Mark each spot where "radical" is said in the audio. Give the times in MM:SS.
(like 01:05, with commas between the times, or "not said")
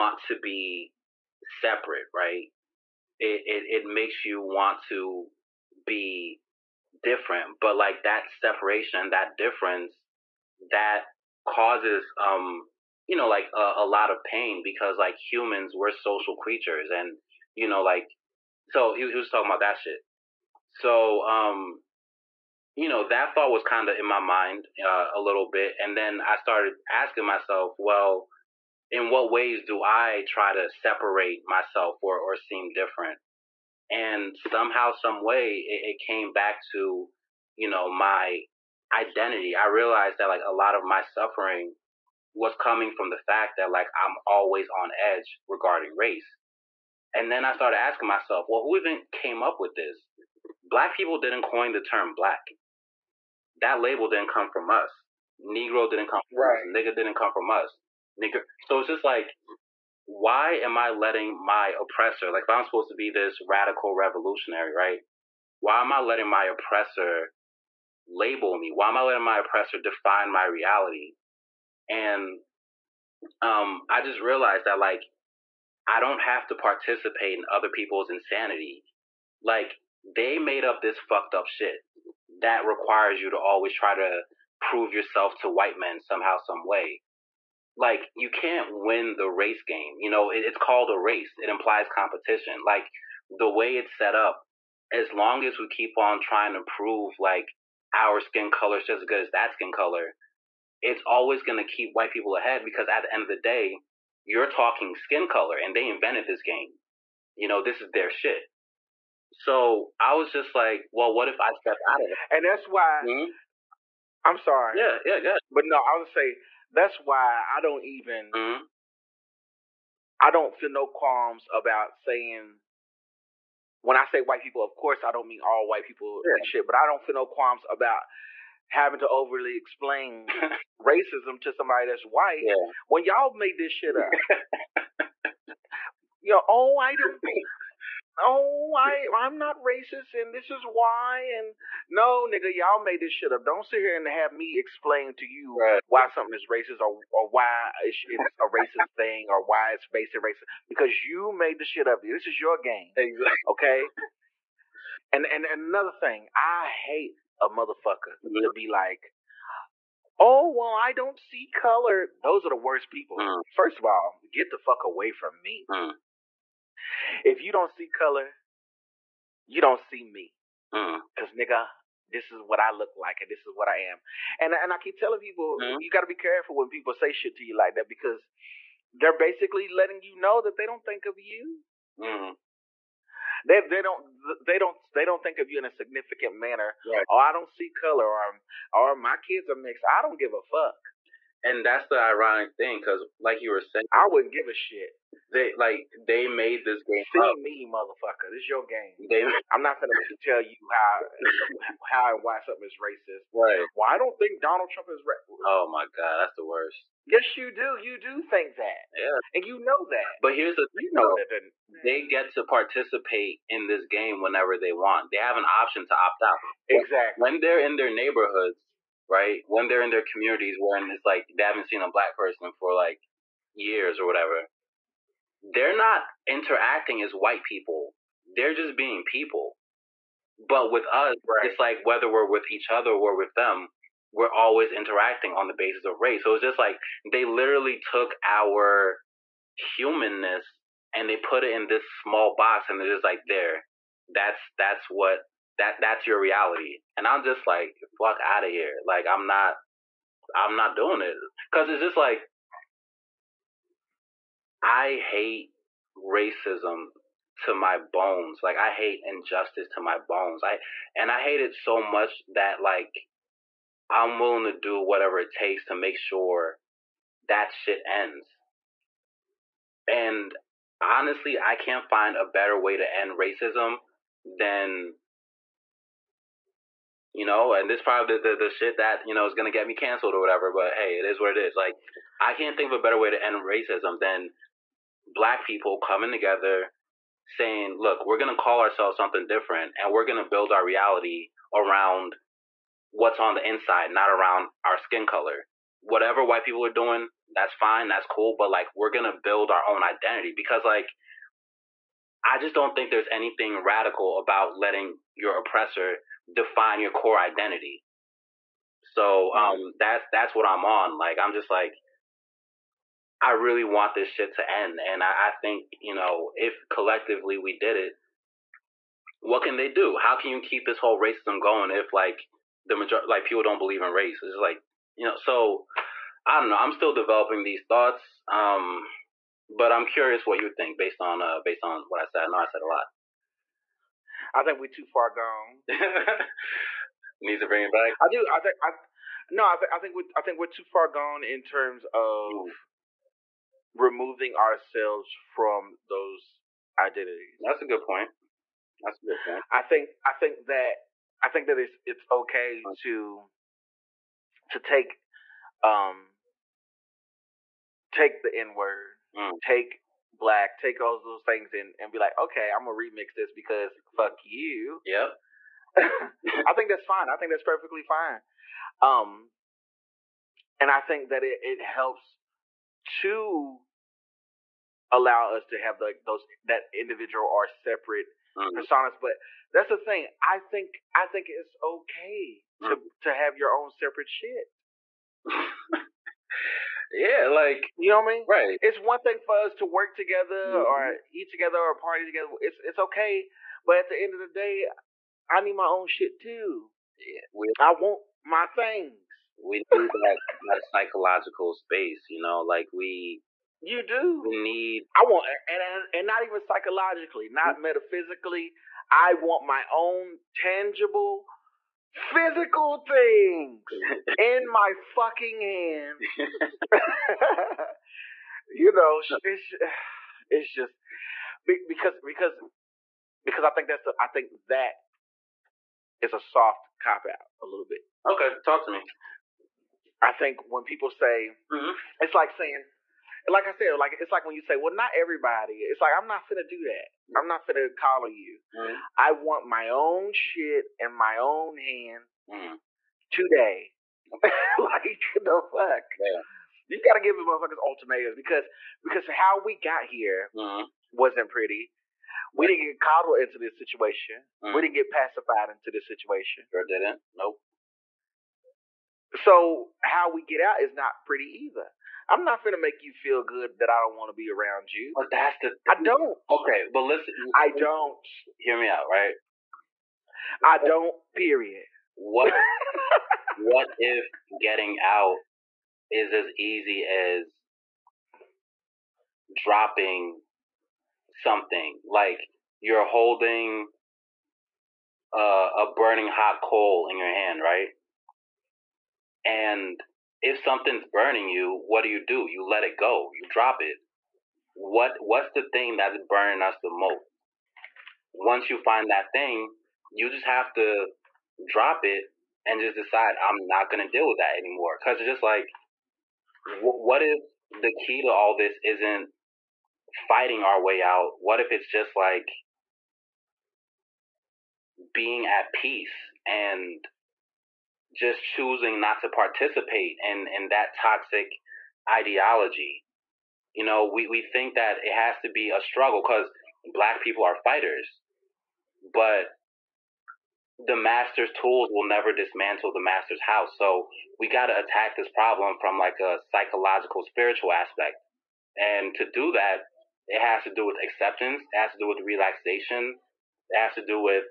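01:03, 05:03.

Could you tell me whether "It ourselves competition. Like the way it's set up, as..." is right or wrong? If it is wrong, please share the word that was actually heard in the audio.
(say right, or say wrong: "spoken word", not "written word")
wrong: "implies", not "ourselves".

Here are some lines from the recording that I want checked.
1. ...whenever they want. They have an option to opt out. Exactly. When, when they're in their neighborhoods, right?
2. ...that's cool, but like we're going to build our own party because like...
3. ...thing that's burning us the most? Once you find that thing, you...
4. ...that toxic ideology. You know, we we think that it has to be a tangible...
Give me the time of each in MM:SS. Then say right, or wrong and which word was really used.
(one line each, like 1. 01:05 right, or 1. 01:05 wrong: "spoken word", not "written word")
1. 03:34 right
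2. 04:57 wrong: "identity", not "party"
3. 08:15 right
4. 08:40 wrong: "struggle", not "tangible".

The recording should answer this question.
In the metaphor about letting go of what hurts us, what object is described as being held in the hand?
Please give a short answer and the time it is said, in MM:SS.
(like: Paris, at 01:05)
a burning hot coal, at 08:05.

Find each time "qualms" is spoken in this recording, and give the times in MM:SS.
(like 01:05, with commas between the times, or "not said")
02:00, 02:07.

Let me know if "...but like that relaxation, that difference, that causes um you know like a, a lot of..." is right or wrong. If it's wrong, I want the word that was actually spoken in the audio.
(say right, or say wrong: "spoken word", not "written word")
wrong: "separation", not "relaxation".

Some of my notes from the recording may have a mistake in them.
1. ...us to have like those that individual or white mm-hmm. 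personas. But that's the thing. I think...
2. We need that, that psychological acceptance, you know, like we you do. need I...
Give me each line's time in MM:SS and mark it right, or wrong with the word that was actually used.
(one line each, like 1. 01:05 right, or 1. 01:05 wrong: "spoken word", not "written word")
1. 06:15 wrong: "separate", not "white"
2. 06:39 wrong: "space", not "acceptance".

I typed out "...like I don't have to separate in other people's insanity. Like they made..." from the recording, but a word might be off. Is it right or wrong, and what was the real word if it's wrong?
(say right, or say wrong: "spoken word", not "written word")
wrong: "participate", not "separate".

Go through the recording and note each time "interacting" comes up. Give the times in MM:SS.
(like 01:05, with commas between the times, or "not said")
03:46, 03:54.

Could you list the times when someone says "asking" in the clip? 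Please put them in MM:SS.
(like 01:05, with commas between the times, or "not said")
00:26, 00:47.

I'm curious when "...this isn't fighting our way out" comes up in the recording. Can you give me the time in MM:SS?
08:28.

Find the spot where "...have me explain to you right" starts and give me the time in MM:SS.
02:24.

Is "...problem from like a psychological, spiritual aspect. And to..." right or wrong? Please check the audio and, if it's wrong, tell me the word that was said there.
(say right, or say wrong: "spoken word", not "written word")
right.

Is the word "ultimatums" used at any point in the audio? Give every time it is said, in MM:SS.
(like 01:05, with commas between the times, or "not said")
07:27.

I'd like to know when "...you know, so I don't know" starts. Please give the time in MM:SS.
05:24.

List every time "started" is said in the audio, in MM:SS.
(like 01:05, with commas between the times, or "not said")
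00:26, 00:47.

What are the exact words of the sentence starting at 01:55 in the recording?
But no, I would say that's why I don't even mm-hmm.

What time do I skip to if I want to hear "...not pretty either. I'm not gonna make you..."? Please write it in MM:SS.
07:40.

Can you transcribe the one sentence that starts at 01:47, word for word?
You know, this is their shit.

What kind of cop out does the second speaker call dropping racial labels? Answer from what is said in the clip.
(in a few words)
a soft cop out.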